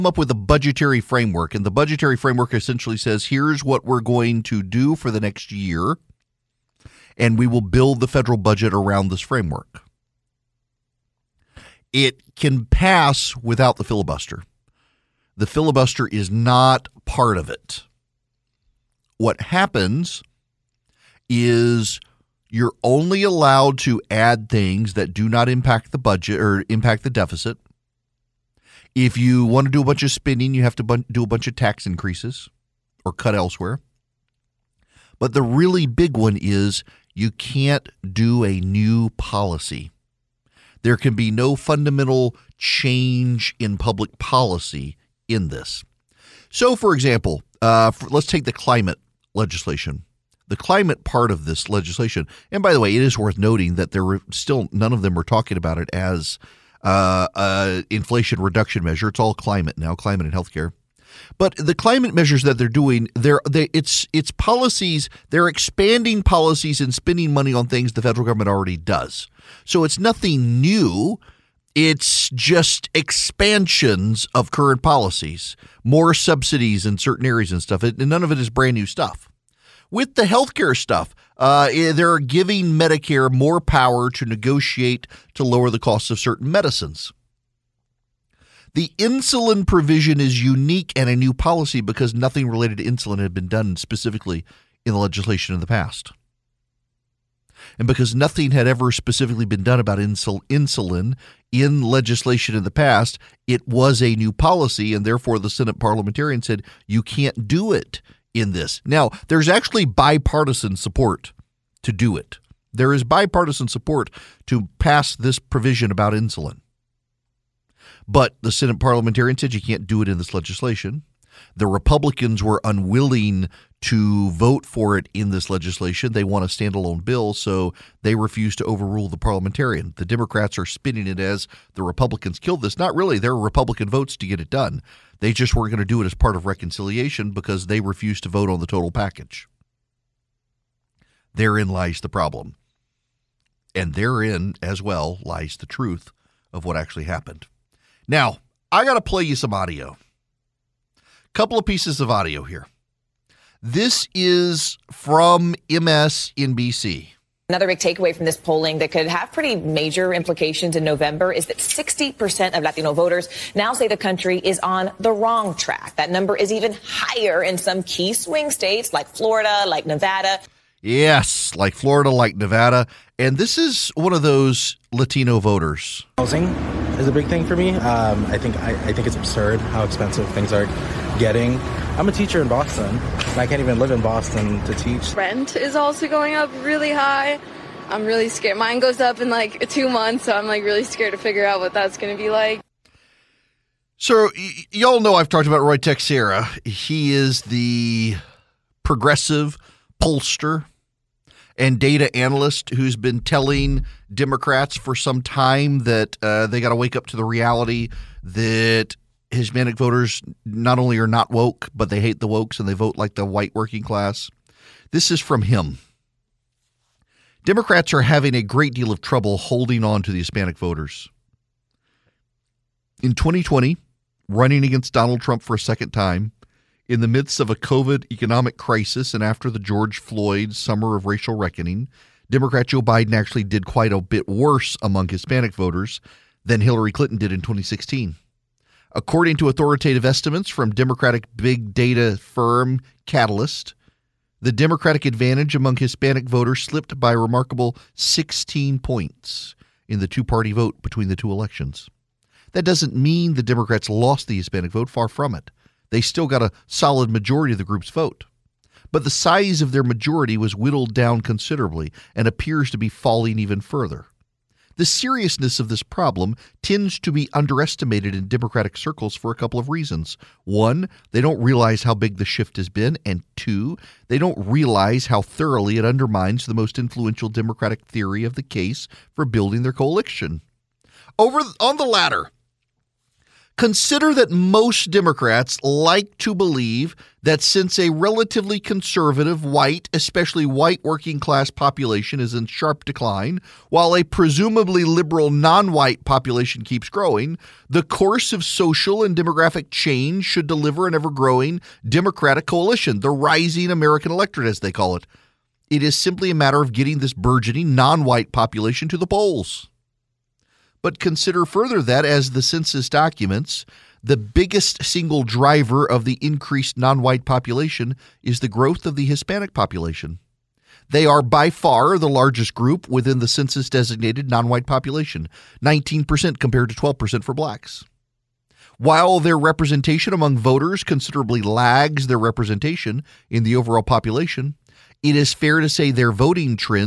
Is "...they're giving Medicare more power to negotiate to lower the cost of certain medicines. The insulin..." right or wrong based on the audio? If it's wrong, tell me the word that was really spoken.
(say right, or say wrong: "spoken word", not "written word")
right.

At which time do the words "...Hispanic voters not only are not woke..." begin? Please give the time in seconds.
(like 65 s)
209 s.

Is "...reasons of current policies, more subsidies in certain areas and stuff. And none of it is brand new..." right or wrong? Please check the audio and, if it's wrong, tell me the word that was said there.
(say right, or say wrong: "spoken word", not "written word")
wrong: "expansions", not "reasons".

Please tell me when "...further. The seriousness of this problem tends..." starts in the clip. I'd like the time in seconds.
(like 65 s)
263 s.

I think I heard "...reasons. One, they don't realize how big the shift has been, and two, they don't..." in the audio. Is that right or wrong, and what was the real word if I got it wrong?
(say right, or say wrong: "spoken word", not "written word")
right.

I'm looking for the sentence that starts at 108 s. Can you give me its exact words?
Now, there's actually bipartisan support to do it.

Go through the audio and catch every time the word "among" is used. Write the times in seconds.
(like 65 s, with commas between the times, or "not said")
234 s, 245 s, 330 s.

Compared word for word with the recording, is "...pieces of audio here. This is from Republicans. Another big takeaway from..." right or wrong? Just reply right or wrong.
wrong.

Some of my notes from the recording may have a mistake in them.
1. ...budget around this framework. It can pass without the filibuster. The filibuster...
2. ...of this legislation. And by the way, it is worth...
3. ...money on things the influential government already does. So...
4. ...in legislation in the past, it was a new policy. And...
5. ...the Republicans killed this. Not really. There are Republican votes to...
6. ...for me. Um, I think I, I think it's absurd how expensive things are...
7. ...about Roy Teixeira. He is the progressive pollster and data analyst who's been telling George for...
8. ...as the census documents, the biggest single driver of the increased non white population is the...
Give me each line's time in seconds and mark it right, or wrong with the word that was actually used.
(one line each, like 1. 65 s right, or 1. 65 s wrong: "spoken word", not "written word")
1. 8 s right
2. 51 s right
3. 67 s wrong: "federal", not "influential"
4. 101 s right
5. 131 s right
6. 177 s right
7. 195 s wrong: "Democrats", not "George"
8. 312 s right.